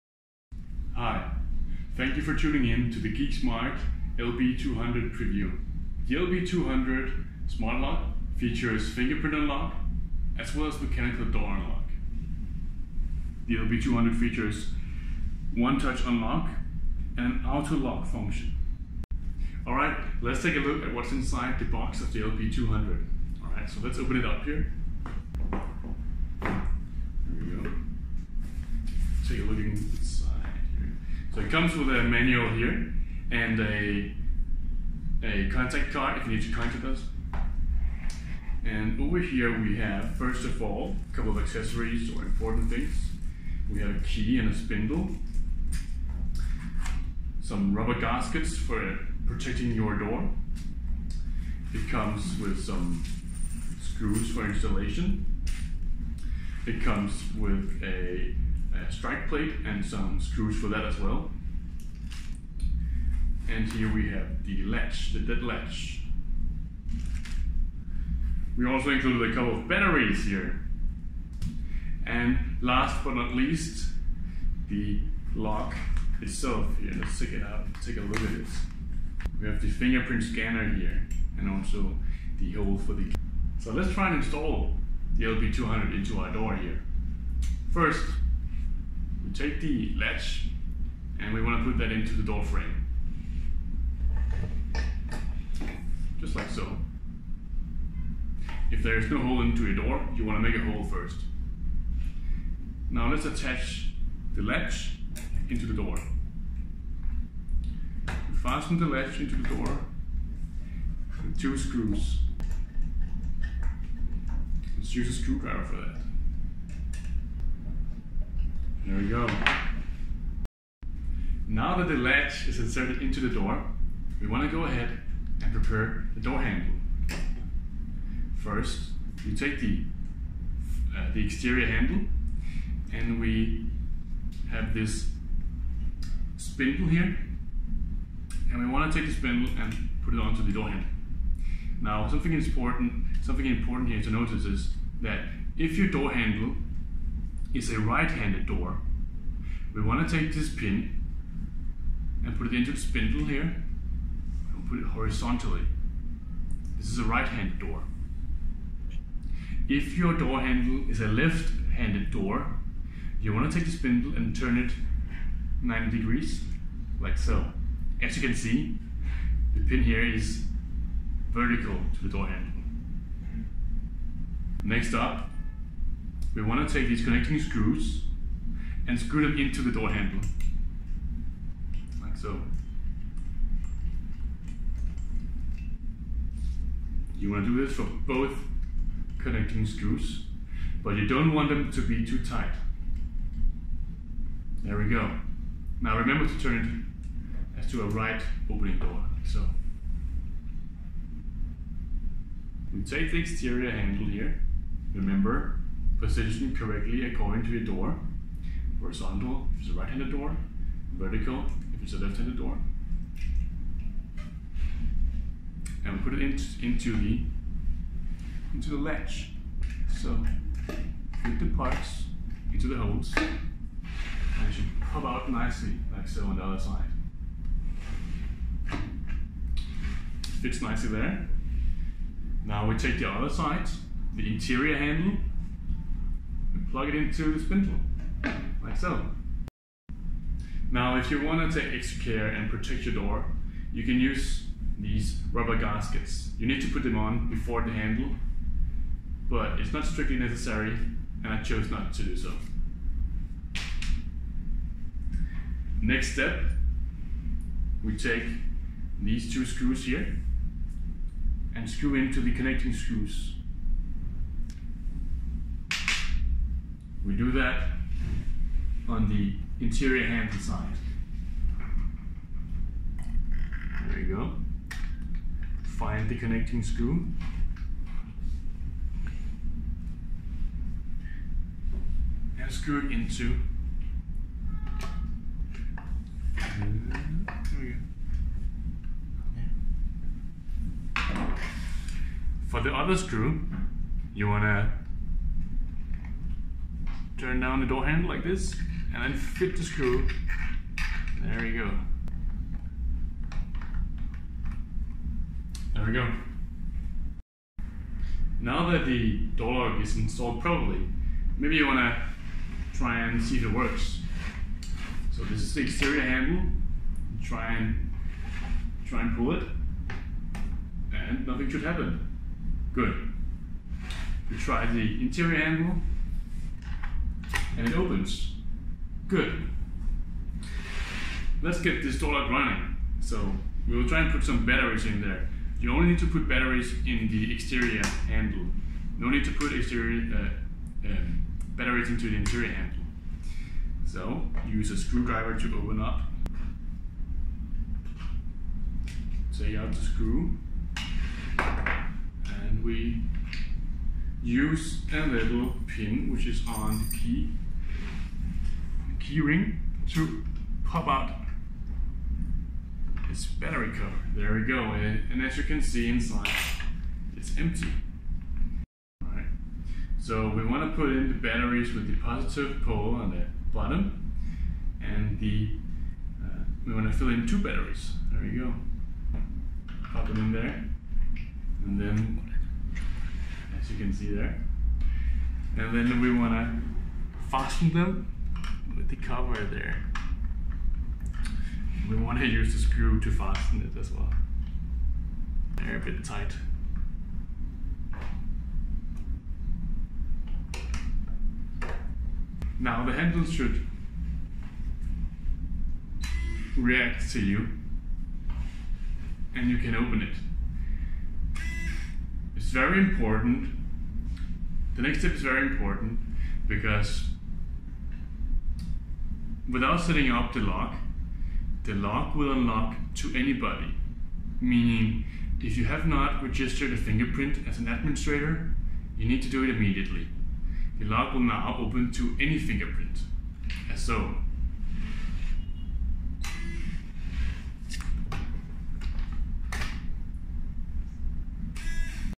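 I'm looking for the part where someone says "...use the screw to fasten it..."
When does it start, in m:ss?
6:32.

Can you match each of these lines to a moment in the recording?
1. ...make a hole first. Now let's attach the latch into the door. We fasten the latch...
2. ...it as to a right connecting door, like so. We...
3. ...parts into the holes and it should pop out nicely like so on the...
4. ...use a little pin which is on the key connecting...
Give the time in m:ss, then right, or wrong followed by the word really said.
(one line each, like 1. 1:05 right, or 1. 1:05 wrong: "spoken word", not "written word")
1. 1:40 right
2. 3:17 wrong: "opening", not "connecting"
3. 3:41 right
4. 5:54 wrong: "hearing", not "connecting".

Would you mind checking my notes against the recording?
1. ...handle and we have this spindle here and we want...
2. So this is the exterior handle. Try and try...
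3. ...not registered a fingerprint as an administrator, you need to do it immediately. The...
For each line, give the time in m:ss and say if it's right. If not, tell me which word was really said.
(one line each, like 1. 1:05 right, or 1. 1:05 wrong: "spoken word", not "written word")
1. 2:11 right
2. 5:15 right
3. 7:05 right.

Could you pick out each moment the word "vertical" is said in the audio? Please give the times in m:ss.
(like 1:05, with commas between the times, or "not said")
2:51, 3:30.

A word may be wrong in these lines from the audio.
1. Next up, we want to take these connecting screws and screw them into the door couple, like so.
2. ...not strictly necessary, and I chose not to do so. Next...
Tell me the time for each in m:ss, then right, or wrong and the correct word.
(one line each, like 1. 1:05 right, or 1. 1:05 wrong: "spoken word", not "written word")
1. 2:54 wrong: "handle", not "couple"
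2. 4:09 right.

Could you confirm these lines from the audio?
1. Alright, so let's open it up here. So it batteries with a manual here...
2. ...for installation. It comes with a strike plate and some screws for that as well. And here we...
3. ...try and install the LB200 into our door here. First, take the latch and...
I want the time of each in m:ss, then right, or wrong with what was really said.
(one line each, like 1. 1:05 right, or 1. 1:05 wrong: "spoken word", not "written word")
1. 0:23 wrong: "comes", not "batteries"
2. 0:54 right
3. 1:23 right.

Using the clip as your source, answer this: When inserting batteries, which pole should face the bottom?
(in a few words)
positive pole.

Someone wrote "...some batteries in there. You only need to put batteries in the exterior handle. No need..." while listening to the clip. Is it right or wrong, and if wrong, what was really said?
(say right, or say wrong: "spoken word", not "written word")
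right.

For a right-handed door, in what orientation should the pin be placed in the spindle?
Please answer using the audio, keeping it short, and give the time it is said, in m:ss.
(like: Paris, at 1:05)
horizontally, at 2:34.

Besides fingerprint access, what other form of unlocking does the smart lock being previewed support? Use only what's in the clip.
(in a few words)
mechanical door unlock.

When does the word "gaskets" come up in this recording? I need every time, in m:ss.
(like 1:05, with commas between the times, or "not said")
0:47, 4:05.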